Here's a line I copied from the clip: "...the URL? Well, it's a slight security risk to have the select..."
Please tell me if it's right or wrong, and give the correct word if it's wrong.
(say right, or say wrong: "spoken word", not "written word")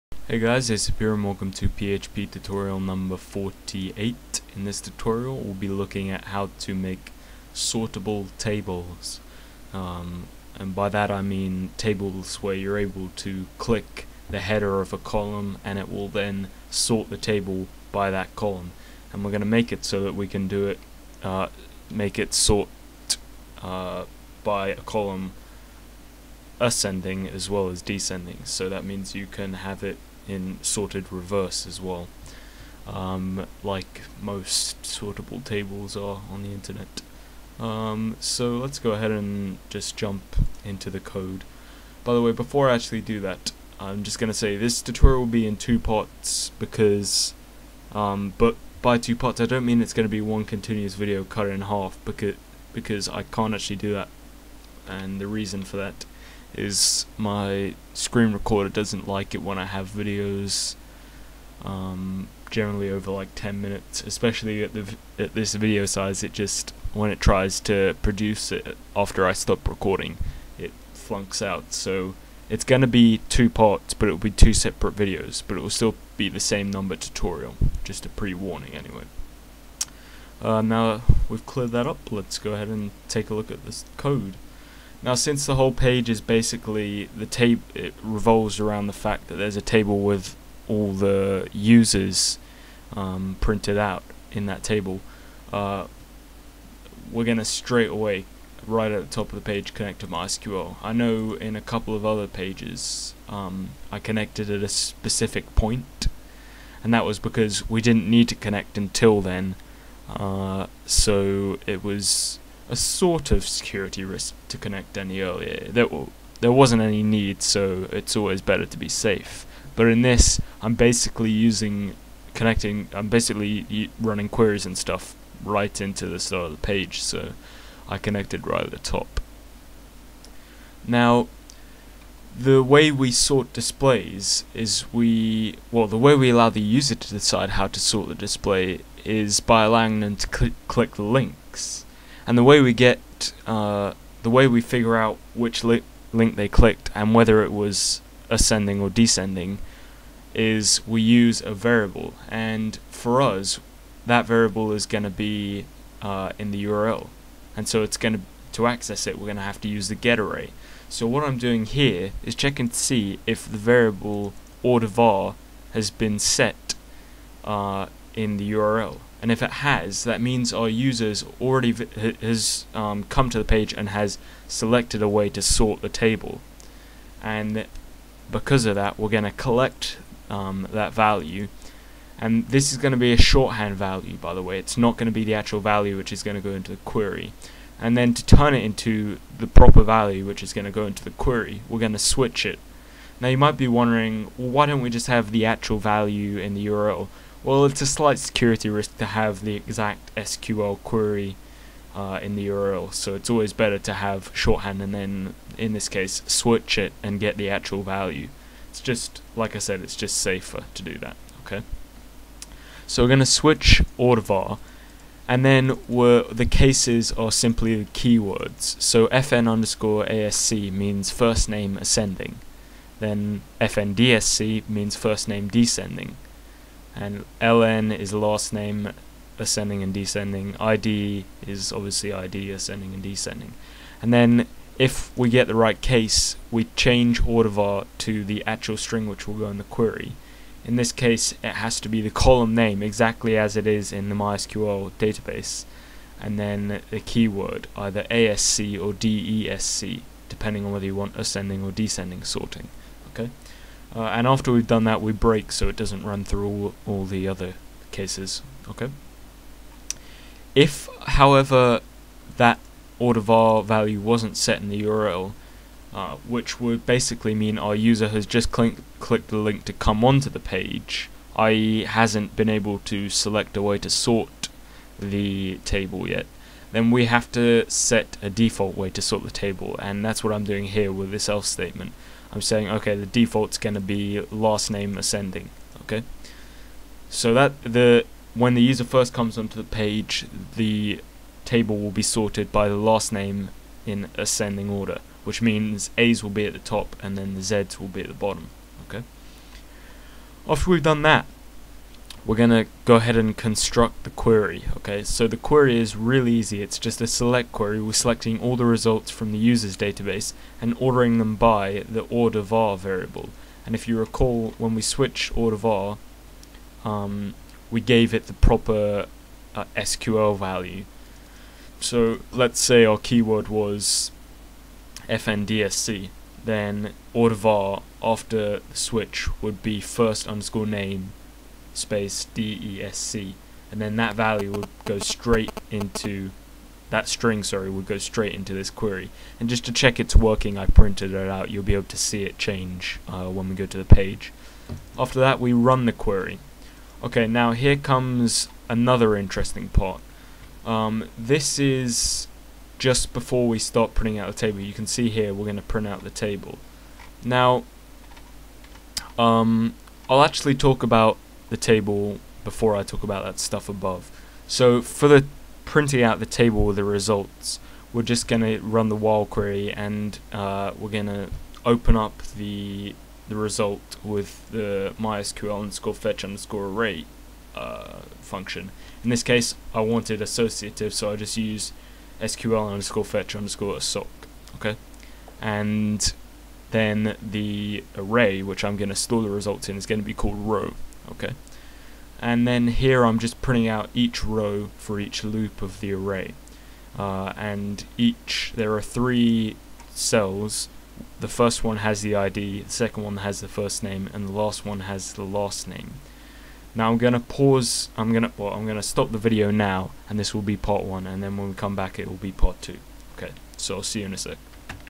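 wrong: "exact", not "select".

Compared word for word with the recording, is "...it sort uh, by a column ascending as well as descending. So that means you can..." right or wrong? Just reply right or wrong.
right.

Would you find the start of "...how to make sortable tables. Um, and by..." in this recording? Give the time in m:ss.
0:06.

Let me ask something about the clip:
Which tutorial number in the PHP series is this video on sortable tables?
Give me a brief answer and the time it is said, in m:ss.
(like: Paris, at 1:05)
48, at 0:03.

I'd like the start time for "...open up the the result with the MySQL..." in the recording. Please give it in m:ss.
6:11.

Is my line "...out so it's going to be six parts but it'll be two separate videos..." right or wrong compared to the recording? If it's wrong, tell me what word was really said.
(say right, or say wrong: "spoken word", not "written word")
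wrong: "two", not "six".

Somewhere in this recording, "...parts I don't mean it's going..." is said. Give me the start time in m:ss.
0:49.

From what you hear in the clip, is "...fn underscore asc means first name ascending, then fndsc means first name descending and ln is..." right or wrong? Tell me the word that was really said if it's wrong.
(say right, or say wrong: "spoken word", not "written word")
right.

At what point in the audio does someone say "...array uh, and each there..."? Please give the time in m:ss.
6:35.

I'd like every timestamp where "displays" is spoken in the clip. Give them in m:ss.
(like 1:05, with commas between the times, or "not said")
2:13, 2:18.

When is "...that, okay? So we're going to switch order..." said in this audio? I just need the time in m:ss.
3:30.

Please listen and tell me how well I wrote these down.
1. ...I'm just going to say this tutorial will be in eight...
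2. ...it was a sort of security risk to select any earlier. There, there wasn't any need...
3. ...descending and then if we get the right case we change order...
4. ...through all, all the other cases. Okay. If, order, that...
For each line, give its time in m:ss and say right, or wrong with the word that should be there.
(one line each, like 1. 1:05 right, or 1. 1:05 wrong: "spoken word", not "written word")
1. 0:43 wrong: "two", not "eight"
2. 1:51 wrong: "connect", not "select"
3. 3:53 right
4. 4:16 wrong: "however", not "order".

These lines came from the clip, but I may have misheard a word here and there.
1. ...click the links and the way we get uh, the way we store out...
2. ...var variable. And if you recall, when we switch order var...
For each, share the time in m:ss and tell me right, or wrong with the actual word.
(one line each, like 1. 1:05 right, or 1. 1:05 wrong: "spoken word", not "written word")
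1. 2:20 wrong: "figure", not "store"
2. 5:12 right.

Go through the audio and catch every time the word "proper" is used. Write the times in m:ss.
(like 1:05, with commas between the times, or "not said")
3:09, 5:18.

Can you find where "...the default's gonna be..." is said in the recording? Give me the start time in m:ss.
4:42.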